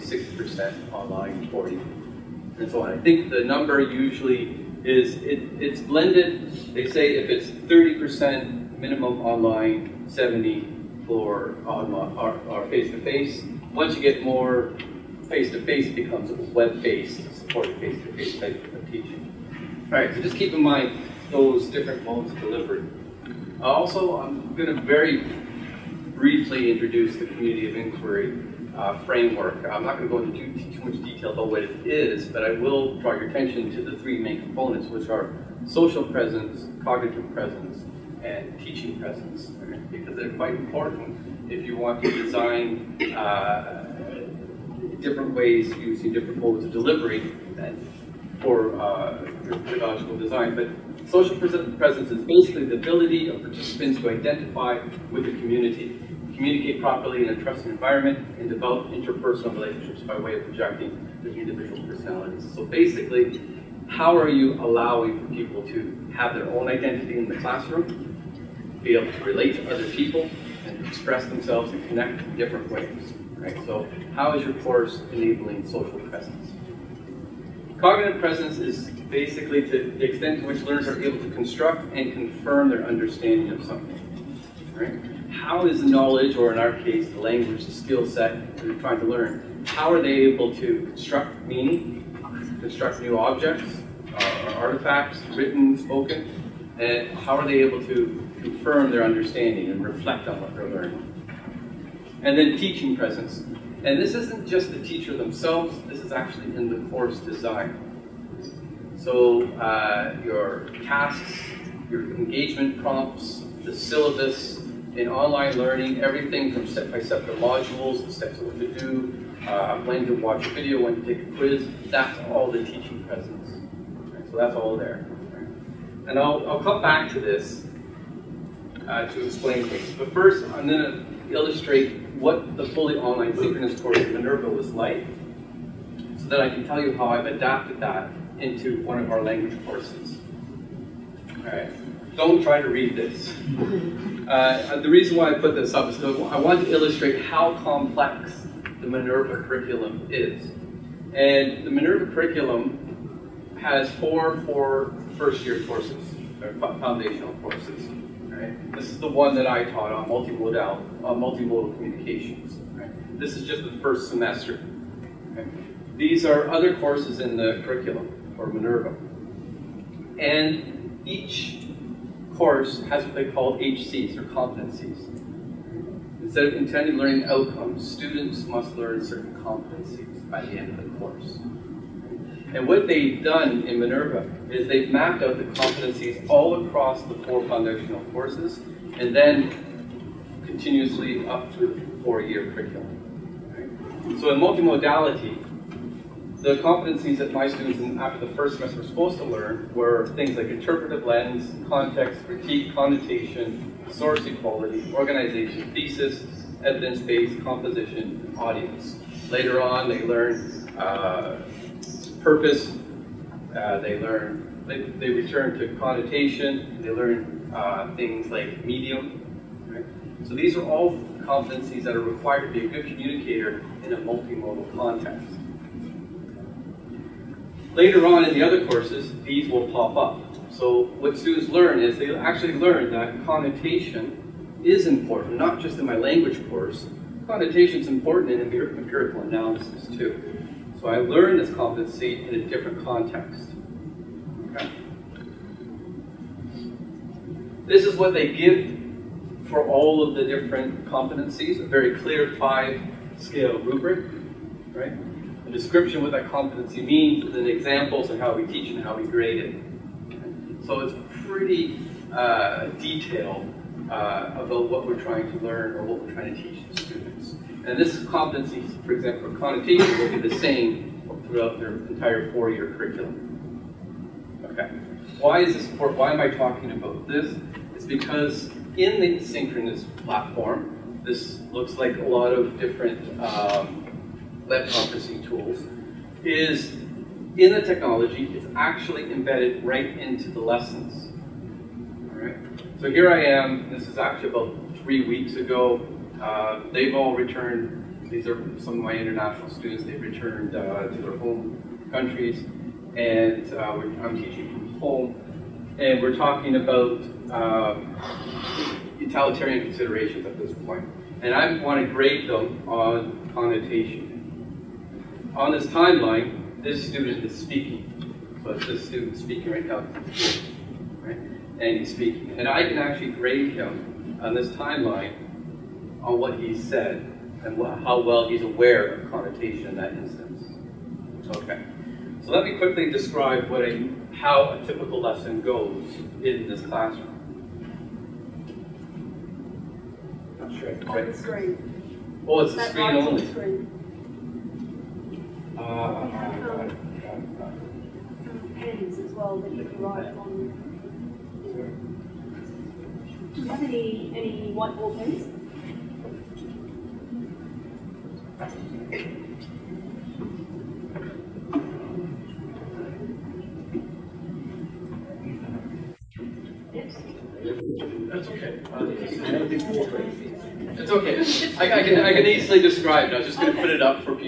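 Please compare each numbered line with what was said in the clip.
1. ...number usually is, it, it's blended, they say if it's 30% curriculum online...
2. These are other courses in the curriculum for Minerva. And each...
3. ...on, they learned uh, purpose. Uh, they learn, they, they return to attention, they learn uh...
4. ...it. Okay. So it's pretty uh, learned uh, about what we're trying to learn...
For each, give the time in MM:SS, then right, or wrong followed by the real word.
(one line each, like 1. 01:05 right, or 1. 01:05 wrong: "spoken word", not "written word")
1. 00:03 wrong: "minimum", not "curriculum"
2. 02:45 right
3. 03:29 wrong: "connotation", not "attention"
4. 04:19 wrong: "detailed", not "learned".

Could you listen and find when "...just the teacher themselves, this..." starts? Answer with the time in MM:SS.
01:44.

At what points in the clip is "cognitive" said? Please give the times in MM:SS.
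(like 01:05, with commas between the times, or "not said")
00:36, 01:17.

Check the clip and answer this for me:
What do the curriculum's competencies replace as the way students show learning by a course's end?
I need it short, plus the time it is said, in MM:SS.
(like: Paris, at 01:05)
intended learning outcomes, at 02:56.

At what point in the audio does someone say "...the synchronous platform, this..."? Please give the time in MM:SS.
04:38.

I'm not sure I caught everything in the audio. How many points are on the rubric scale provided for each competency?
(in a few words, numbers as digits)
5.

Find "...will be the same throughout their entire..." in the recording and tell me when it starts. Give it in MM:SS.
04:29.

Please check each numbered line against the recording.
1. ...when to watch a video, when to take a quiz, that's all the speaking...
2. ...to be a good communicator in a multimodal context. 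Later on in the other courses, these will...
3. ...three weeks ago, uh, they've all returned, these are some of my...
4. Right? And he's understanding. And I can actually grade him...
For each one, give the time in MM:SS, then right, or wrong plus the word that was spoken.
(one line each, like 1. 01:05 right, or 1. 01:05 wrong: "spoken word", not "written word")
1. 01:59 wrong: "teaching", not "speaking"
2. 03:42 right
3. 04:54 right
4. 05:20 wrong: "speaking", not "understanding".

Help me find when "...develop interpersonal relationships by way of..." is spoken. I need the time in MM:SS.
00:58.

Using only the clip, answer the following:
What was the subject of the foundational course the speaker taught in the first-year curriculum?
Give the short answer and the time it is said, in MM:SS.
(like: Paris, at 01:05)
multimodal communications, at 02:41.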